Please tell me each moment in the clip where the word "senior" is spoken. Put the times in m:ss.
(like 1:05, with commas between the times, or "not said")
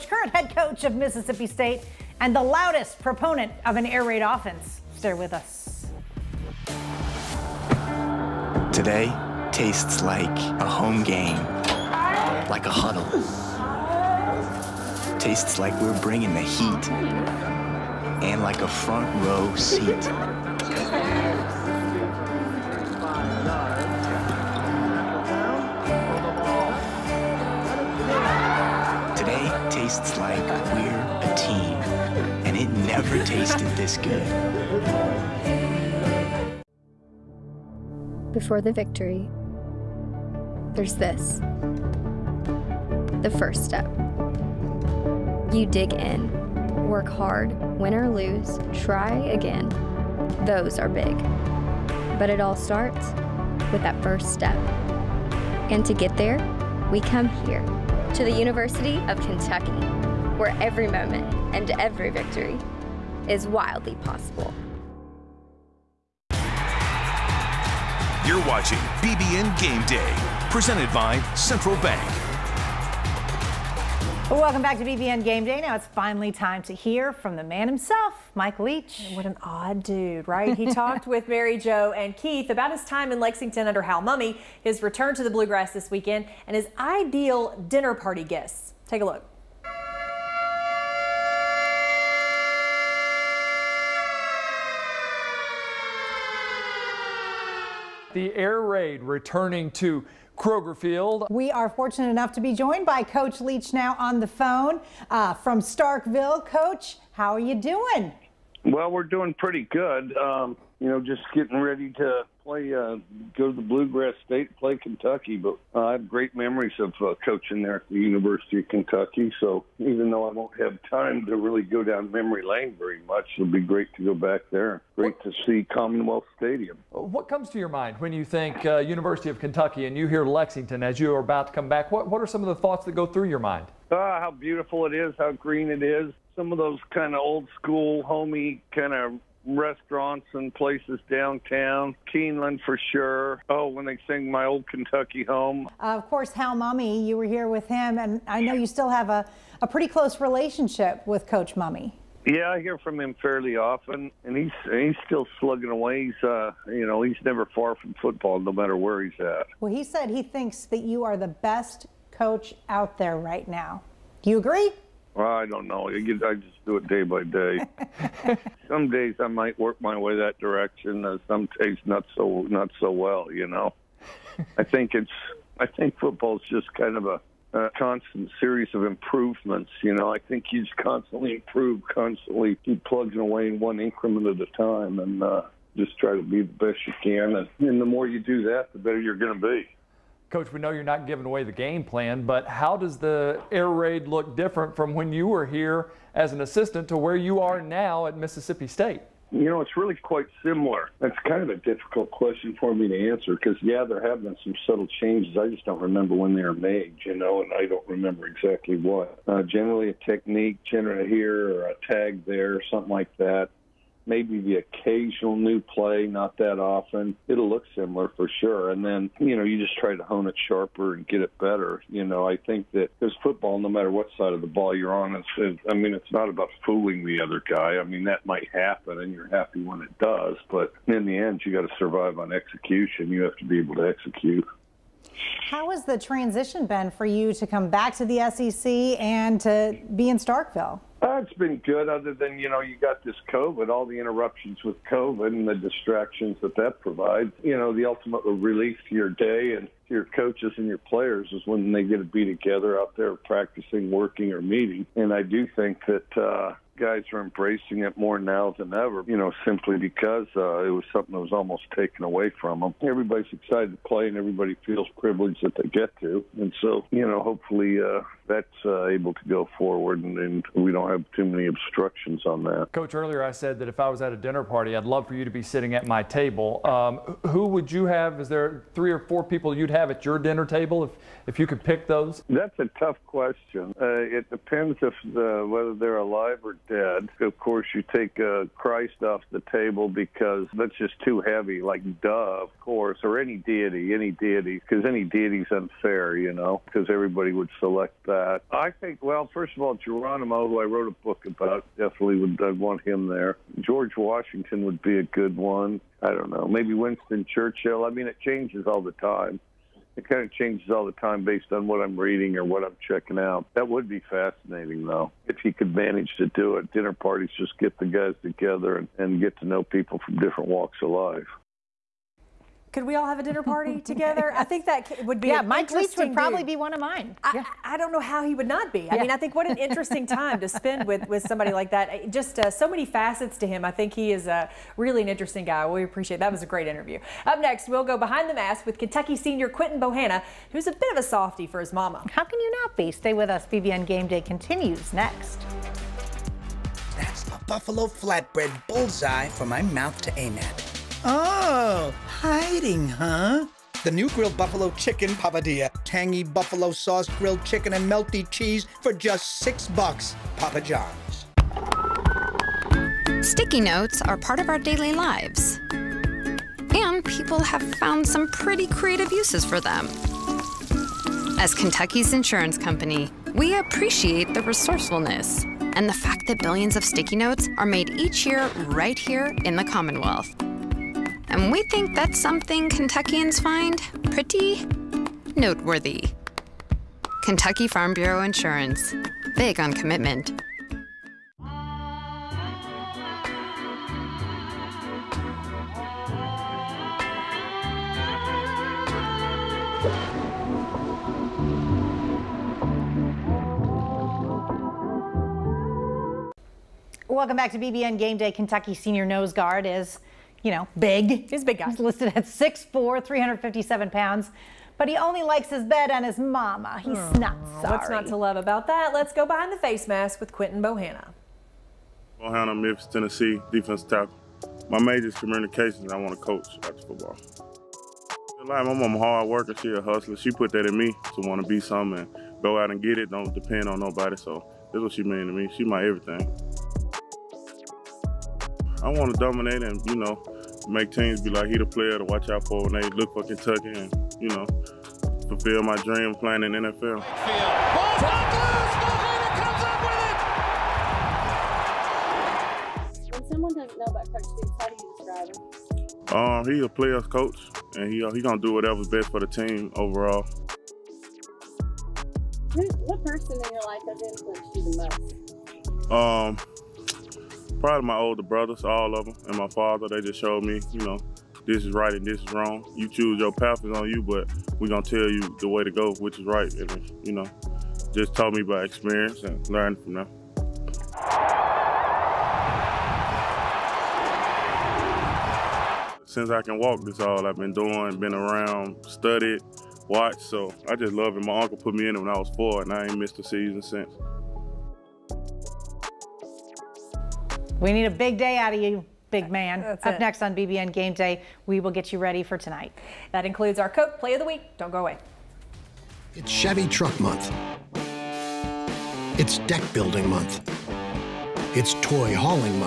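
5:39, 6:48.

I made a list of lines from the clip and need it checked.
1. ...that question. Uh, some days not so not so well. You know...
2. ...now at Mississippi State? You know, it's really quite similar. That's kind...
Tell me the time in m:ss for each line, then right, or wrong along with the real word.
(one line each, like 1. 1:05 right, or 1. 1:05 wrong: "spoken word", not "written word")
1. 2:50 wrong: "direction", not "question"
2. 3:17 right.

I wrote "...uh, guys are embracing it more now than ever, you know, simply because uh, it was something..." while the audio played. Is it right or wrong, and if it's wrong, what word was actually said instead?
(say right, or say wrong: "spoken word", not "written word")
right.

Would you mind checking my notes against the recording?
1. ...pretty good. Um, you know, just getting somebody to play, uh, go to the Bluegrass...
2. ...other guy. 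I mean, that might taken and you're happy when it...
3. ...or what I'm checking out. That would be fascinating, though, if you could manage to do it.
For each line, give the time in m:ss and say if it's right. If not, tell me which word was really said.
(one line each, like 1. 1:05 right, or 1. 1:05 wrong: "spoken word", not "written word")
1. 1:49 wrong: "ready", not "somebody"
2. 3:47 wrong: "happen", not "taken"
3. 5:12 right.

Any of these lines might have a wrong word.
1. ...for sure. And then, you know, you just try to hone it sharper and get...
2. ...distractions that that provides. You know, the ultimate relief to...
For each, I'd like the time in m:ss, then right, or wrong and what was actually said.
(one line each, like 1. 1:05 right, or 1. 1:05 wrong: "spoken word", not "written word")
1. 3:38 right
2. 4:05 right.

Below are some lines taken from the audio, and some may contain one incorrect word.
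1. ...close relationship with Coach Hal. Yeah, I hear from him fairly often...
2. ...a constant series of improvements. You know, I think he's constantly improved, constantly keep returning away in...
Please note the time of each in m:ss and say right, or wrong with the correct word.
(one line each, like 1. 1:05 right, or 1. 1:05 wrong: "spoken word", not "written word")
1. 2:29 wrong: "Mumme", not "Hal"
2. 2:57 wrong: "plugging", not "returning".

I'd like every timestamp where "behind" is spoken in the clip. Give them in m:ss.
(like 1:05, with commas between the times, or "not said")
5:37, 6:59.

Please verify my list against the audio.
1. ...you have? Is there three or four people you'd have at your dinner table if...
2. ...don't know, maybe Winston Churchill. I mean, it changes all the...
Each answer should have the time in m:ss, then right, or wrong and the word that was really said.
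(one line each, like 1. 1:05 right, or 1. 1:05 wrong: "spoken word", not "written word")
1. 4:37 right
2. 5:06 right.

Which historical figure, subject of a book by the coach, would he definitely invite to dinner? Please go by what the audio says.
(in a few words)
Geronimo.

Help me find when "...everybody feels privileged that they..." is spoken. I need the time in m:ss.
4:24.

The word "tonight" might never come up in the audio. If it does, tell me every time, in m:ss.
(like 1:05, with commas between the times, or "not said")
8:22.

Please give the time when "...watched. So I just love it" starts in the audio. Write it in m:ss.
8:09.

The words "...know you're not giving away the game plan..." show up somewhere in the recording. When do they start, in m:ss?
3:10.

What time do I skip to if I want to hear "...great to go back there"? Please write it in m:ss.
2:03.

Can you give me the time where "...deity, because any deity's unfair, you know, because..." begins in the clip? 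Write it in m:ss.
4:54.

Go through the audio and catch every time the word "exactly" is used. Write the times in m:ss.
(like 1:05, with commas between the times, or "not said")
3:28.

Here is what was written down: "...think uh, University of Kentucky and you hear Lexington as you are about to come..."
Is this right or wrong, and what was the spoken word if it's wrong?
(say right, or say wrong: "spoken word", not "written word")
right.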